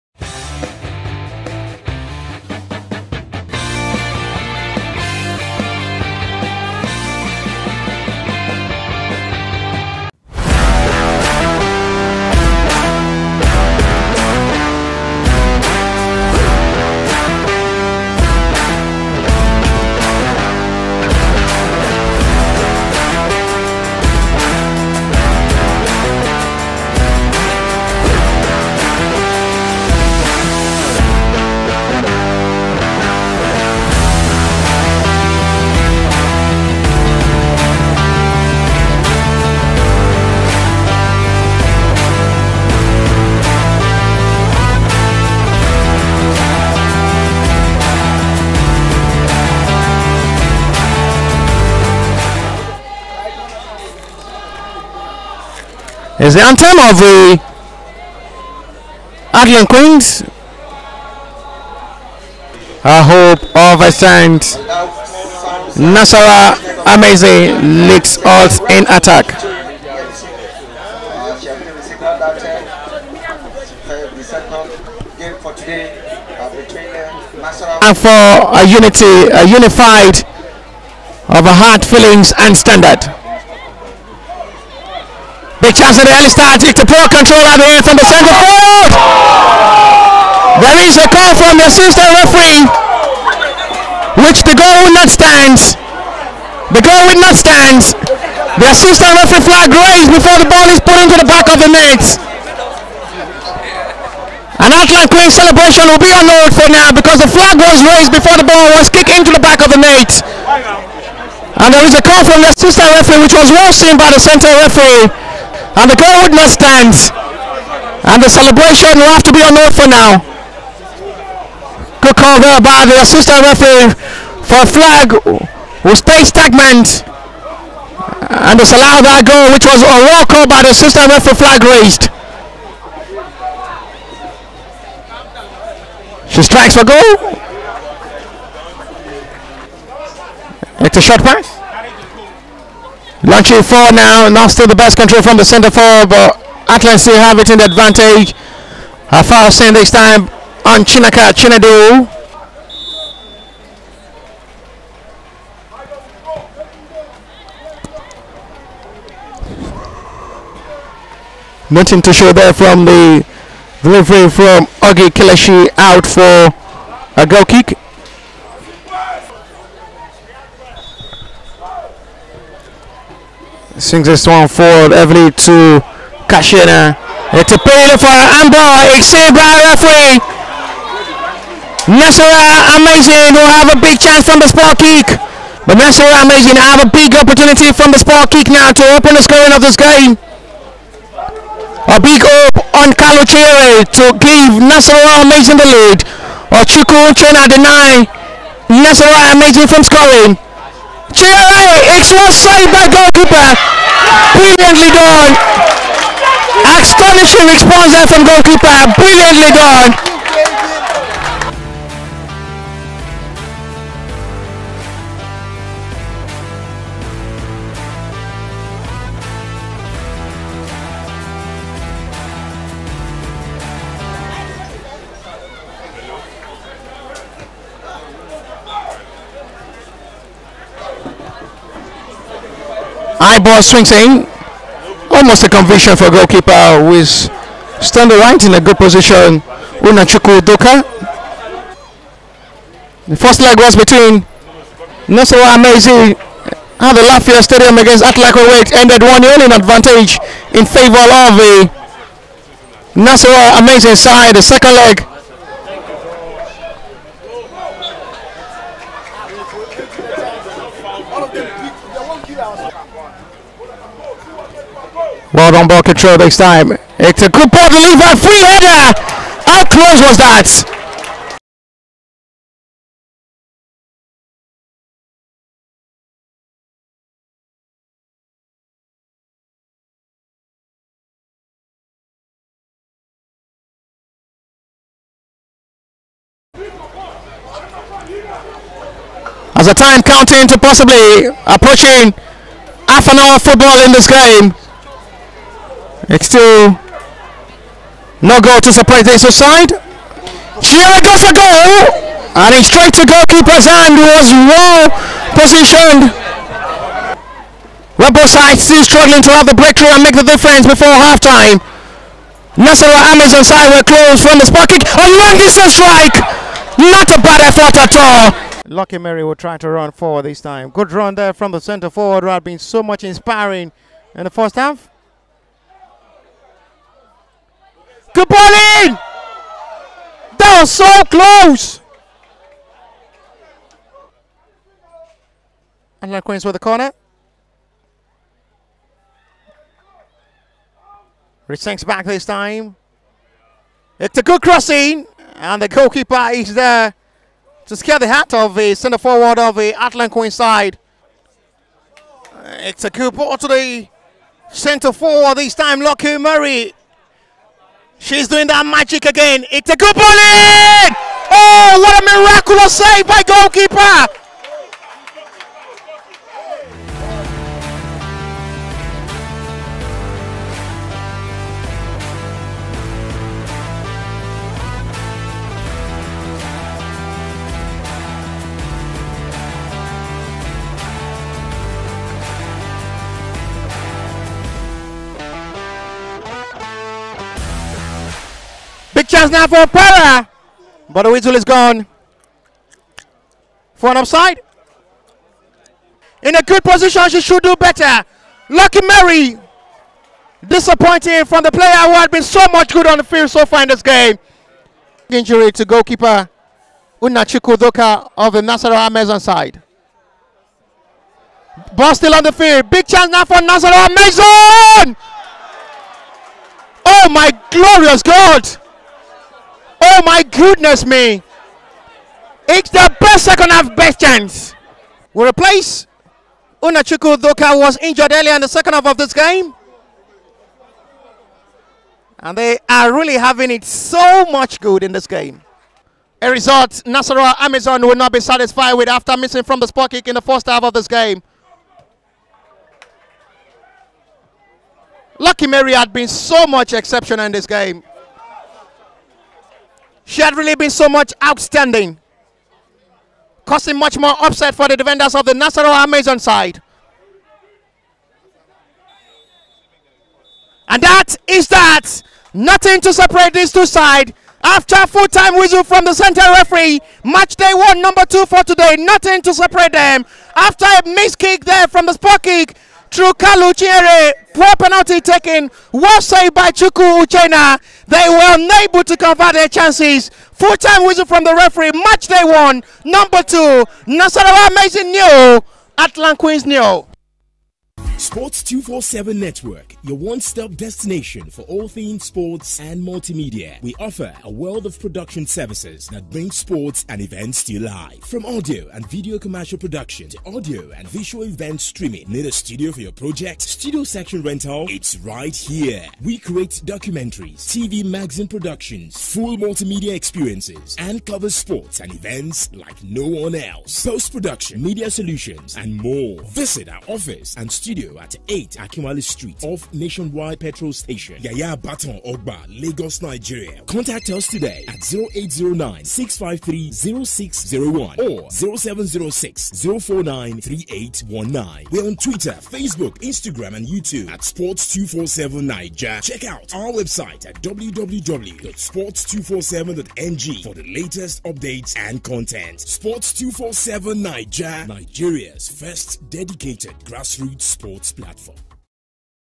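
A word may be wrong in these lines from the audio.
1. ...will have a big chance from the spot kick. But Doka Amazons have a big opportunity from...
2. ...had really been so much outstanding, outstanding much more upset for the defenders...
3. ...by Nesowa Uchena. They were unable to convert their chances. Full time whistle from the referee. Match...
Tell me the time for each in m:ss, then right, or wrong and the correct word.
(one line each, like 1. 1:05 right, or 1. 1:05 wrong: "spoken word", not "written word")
1. 3:03 wrong: "Nasarawa", not "Doka"
2. 7:30 wrong: "causing", not "outstanding"
3. 7:56 wrong: "Chuku", not "Nesowa".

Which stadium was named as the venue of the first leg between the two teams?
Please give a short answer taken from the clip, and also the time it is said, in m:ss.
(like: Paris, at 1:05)
Lafia Stadium, at 4:07.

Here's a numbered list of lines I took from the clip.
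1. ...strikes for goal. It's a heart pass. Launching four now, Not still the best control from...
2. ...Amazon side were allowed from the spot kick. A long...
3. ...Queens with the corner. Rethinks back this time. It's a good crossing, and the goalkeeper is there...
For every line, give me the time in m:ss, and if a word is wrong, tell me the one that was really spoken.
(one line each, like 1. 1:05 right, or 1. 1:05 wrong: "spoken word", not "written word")
1. 2:16 wrong: "short", not "heart"
2. 5:13 wrong: "closed", not "allowed"
3. 5:36 right.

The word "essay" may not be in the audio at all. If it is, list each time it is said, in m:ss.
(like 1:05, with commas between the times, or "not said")
not said.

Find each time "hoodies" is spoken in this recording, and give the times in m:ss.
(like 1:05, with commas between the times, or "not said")
not said.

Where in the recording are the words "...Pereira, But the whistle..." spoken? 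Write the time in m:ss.
6:29.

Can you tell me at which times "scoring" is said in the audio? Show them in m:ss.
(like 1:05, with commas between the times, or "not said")
3:09, 3:19.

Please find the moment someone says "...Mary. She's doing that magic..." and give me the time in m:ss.
5:56.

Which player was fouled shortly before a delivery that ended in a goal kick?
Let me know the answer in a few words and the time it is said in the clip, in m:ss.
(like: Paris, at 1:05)
Chinaka Chinedu, at 2:30.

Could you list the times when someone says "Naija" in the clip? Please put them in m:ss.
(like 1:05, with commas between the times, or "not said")
8:55, 9:04.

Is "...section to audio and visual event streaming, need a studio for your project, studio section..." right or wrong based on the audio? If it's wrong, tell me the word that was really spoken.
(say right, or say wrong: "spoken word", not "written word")
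wrong: "production", not "section".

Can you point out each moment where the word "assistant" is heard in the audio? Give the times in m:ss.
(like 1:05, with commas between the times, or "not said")
1:31, 1:38, 1:52, 2:03, 2:10.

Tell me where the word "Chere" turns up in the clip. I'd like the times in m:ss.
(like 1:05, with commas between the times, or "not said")
3:13, 7:53.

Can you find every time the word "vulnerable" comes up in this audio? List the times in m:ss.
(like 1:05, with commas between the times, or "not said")
not said.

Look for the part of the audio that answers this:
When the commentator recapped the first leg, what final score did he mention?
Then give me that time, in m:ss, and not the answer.
4:09.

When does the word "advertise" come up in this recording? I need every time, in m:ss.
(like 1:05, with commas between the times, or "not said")
not said.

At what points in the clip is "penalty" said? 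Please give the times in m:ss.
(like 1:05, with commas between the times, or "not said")
2:57, 7:54.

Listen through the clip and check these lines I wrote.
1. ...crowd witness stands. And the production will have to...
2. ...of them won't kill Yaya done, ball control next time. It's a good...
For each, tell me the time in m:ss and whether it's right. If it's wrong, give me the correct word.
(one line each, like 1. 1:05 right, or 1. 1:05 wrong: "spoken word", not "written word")
1. 1:55 wrong: "celebration", not "production"
2. 4:21 wrong: "Well", not "Yaya".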